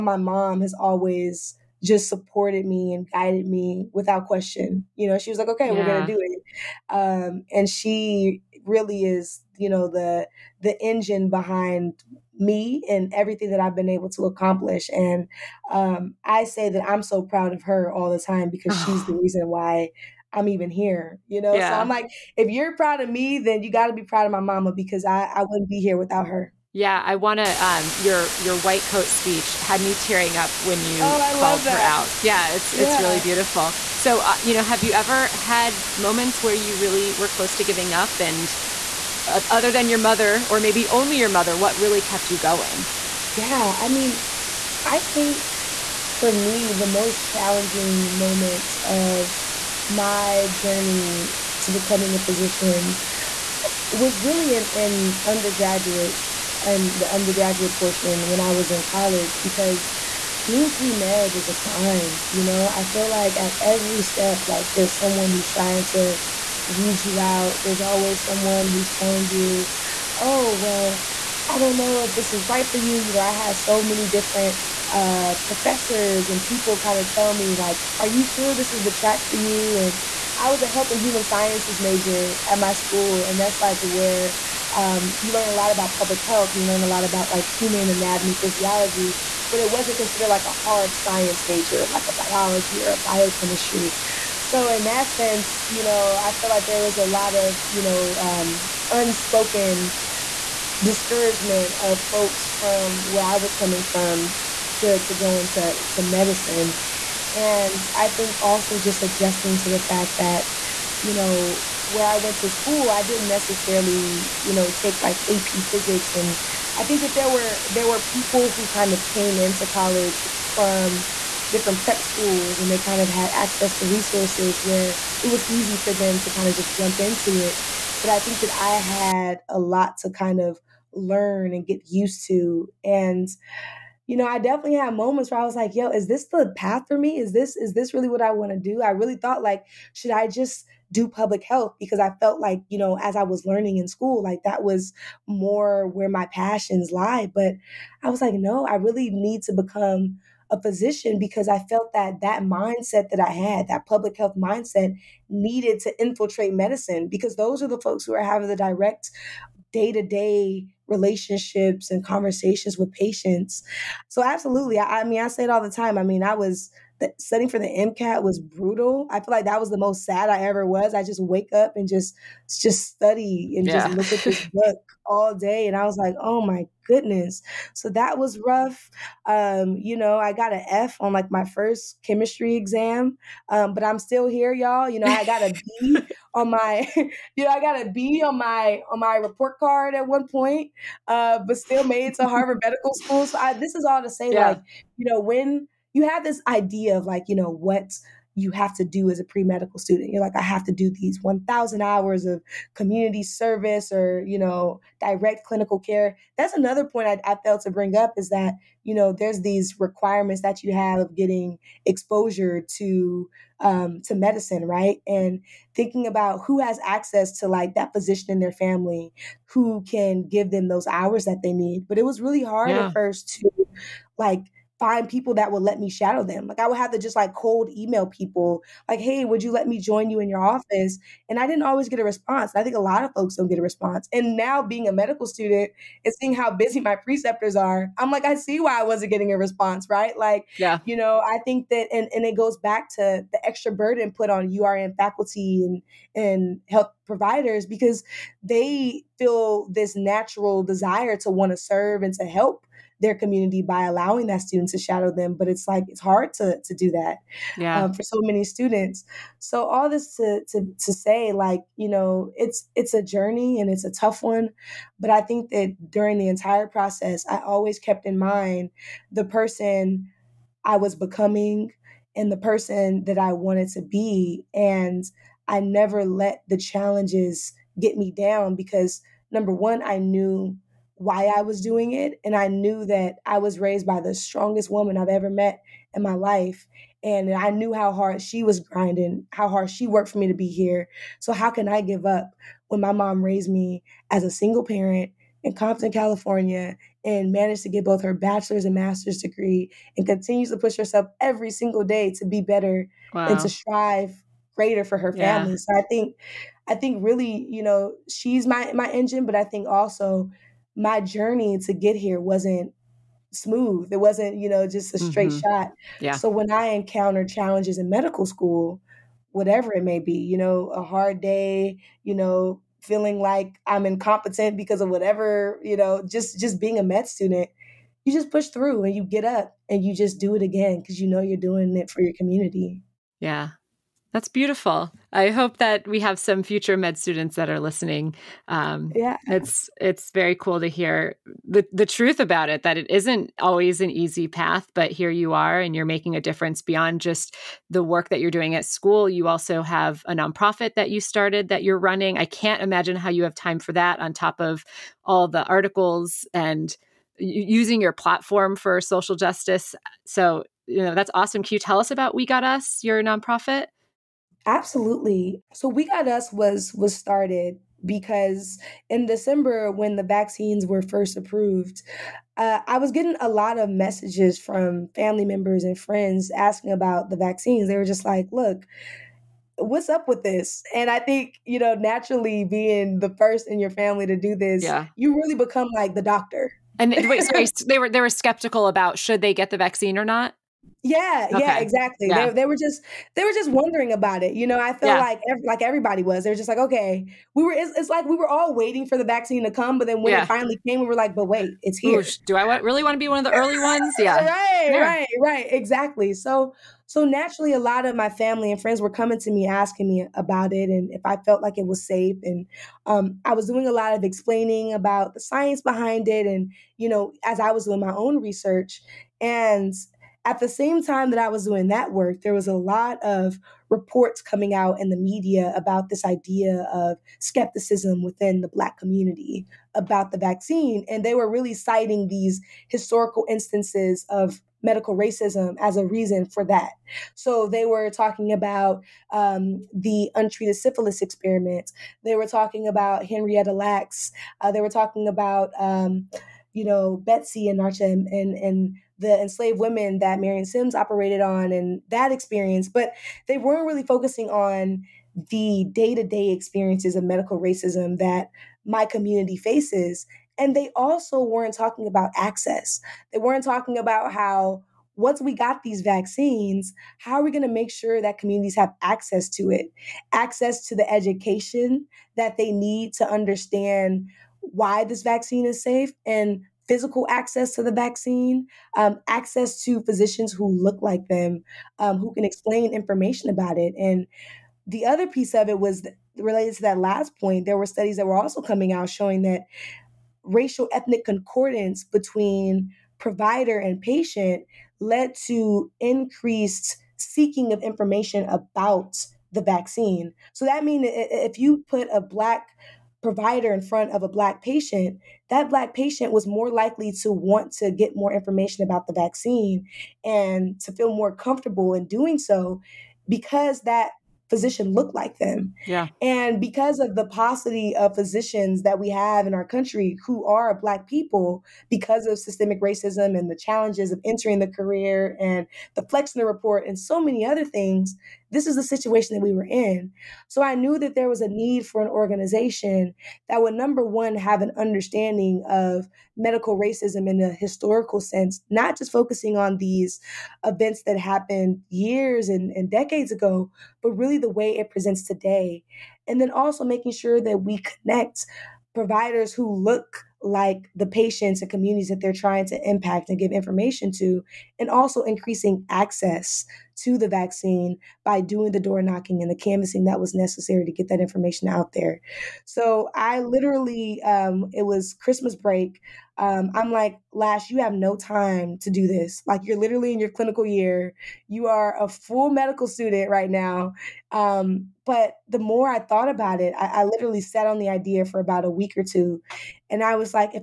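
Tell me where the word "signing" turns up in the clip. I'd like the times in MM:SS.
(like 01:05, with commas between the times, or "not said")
not said.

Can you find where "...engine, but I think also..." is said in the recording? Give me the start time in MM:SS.
05:08.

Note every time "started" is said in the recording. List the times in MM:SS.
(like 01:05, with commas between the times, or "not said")
05:50, 06:06.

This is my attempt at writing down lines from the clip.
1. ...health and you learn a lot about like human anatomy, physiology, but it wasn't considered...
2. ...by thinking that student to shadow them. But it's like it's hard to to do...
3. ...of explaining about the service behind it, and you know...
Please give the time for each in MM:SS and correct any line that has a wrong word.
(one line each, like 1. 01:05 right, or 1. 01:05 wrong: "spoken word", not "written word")
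1. 01:26 right
2. 04:13 wrong: "allowing", not "thinking"
3. 06:53 wrong: "science", not "service".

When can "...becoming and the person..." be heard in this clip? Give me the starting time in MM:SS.
04:30.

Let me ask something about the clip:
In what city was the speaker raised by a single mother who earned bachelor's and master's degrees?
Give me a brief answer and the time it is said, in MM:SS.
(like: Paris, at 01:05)
Compton, California, at 04:55.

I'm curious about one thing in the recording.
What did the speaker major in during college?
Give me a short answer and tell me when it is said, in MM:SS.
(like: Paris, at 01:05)
Health and human sciences, at 01:20.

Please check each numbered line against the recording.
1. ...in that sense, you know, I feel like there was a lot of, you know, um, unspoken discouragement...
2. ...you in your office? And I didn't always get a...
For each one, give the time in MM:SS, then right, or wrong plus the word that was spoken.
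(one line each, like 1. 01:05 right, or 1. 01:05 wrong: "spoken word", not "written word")
1. 01:34 right
2. 03:50 right.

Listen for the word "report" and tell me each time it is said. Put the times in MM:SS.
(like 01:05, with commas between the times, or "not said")
03:09, 07:03, 08:46.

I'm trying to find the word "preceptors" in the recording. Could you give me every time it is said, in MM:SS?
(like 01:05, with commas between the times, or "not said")
03:56.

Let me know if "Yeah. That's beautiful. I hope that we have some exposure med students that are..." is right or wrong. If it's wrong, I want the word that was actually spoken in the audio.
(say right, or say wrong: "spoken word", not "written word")
wrong: "future", not "exposure".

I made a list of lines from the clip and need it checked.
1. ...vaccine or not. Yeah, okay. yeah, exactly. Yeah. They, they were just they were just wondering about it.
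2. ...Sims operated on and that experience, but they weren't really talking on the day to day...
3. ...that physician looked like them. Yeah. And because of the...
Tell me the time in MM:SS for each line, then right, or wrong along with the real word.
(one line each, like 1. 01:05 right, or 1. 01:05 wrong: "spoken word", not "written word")
1. 06:29 right
2. 07:30 wrong: "focusing", not "talking"
3. 08:33 right.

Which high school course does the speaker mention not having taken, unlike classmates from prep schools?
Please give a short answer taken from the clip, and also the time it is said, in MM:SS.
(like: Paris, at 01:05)
AP physics, at 01:55.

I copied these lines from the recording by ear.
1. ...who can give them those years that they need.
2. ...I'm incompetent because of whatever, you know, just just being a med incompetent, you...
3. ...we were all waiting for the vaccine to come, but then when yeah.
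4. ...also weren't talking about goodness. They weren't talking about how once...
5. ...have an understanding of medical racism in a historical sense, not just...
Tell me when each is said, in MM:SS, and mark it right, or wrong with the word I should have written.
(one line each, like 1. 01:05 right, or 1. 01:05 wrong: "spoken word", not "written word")
1. 03:39 wrong: "hours", not "years"
2. 05:23 wrong: "student", not "incompetent"
3. 06:38 right
4. 07:40 wrong: "access", not "goodness"
5. 08:54 right.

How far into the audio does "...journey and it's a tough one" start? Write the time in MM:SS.
04:23.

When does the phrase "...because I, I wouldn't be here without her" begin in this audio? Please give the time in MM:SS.
00:24.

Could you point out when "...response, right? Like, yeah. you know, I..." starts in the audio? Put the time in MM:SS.
03:59.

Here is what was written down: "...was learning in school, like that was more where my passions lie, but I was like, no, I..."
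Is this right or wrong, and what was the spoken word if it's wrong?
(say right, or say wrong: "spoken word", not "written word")
right.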